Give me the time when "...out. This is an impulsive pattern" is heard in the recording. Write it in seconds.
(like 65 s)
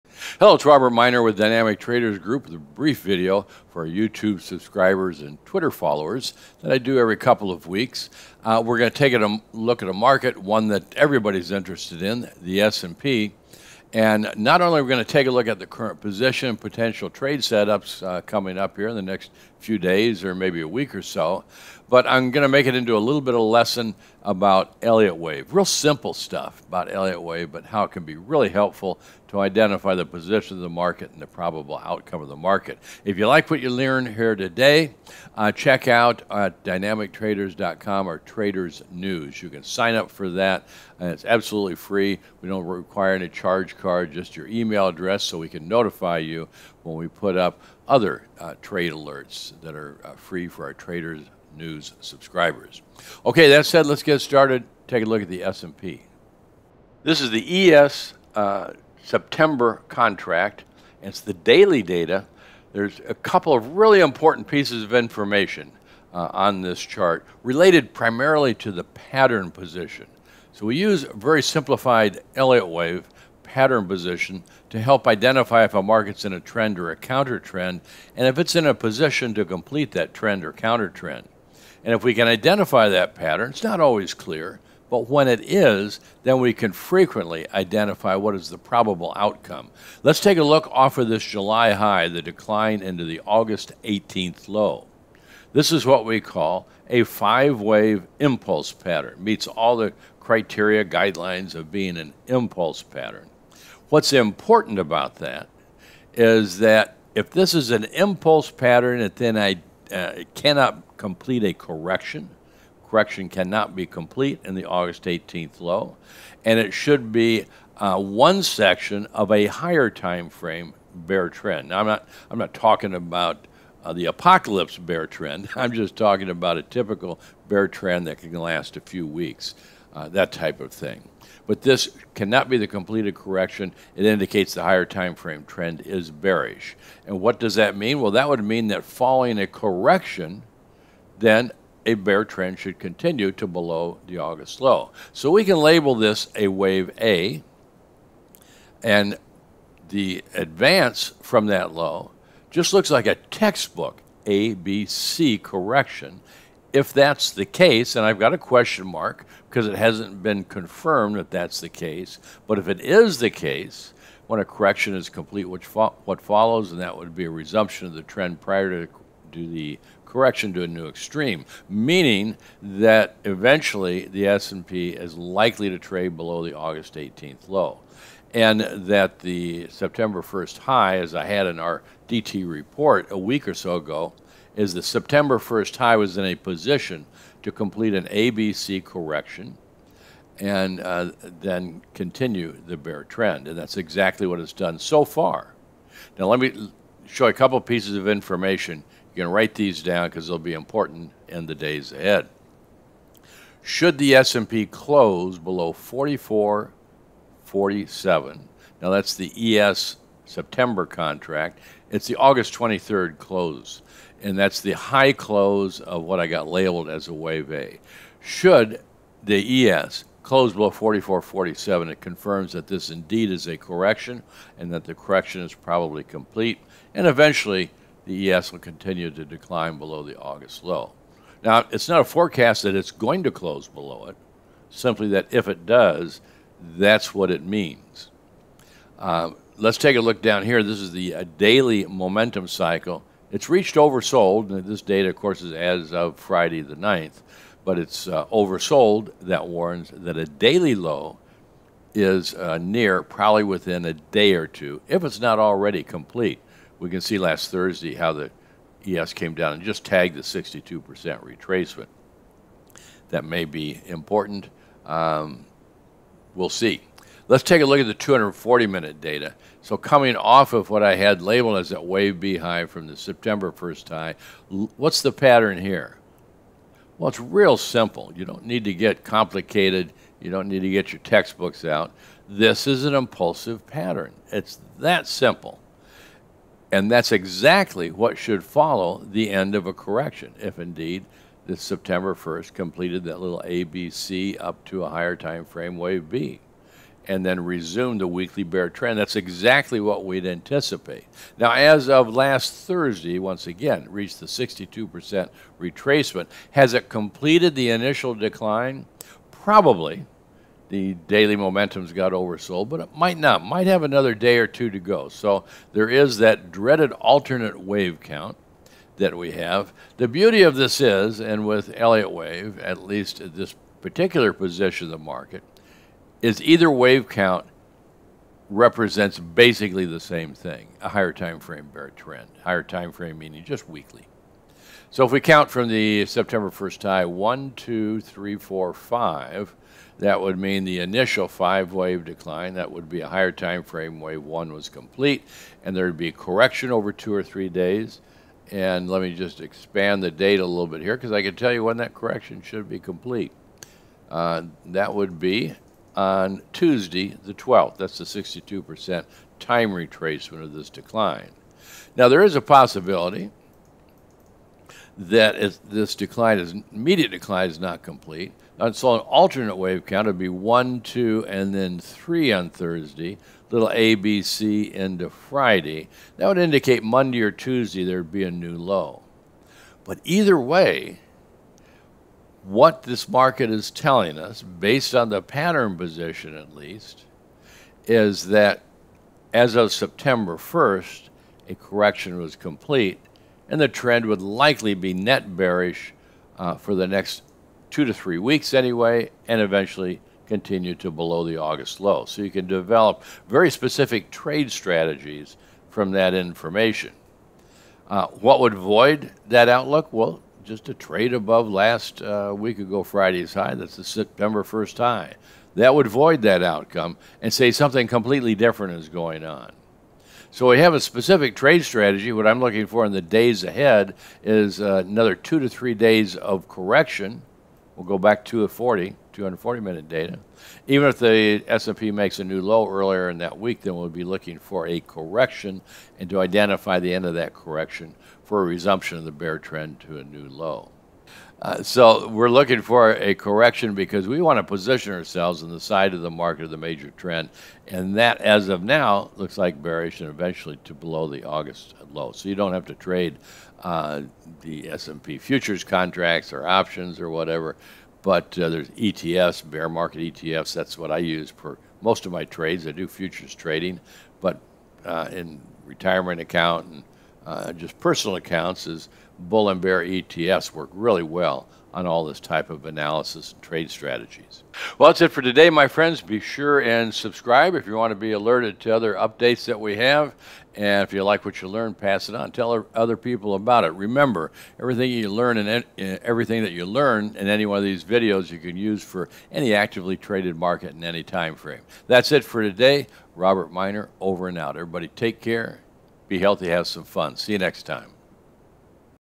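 281 s.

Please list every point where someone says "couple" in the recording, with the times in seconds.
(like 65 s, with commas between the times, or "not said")
7 s, 63 s, 197 s.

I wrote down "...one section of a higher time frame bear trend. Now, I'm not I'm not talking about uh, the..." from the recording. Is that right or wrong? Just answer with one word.
right.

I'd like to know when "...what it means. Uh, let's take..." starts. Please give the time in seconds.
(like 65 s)
237 s.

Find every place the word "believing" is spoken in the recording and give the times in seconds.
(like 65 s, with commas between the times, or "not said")
not said.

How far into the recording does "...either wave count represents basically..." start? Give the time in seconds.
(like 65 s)
326 s.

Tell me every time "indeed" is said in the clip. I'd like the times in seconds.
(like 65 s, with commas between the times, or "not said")
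222 s, 290 s.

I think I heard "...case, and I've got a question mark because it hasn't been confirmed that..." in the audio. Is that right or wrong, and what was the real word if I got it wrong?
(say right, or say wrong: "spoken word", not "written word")
right.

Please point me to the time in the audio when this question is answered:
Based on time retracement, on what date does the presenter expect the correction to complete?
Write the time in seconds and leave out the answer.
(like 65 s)
356 s.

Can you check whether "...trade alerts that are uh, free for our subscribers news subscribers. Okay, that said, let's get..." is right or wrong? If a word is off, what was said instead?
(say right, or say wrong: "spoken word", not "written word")
wrong: "traders", not "subscribers".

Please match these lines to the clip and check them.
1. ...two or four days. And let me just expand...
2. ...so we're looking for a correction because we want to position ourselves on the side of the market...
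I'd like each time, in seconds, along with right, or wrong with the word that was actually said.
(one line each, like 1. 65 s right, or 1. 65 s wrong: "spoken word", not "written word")
1. 346 s wrong: "three", not "four"
2. 441 s right.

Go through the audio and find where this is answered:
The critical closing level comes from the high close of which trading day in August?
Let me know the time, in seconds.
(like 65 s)
212 s.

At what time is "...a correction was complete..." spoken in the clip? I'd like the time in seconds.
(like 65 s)
391 s.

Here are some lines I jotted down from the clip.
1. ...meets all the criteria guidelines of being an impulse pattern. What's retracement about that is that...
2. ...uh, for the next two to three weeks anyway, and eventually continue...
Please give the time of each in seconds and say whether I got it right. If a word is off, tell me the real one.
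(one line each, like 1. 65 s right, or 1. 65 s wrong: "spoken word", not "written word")
1. 99 s wrong: "important", not "retracement"
2. 396 s right.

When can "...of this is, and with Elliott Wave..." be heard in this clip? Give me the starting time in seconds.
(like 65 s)
320 s.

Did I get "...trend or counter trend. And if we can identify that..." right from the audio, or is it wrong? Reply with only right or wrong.
right.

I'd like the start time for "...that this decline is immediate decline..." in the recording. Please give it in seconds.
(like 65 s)
364 s.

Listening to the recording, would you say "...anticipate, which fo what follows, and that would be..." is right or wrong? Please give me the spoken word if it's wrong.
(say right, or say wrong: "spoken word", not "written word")
wrong: "complete", not "anticipate".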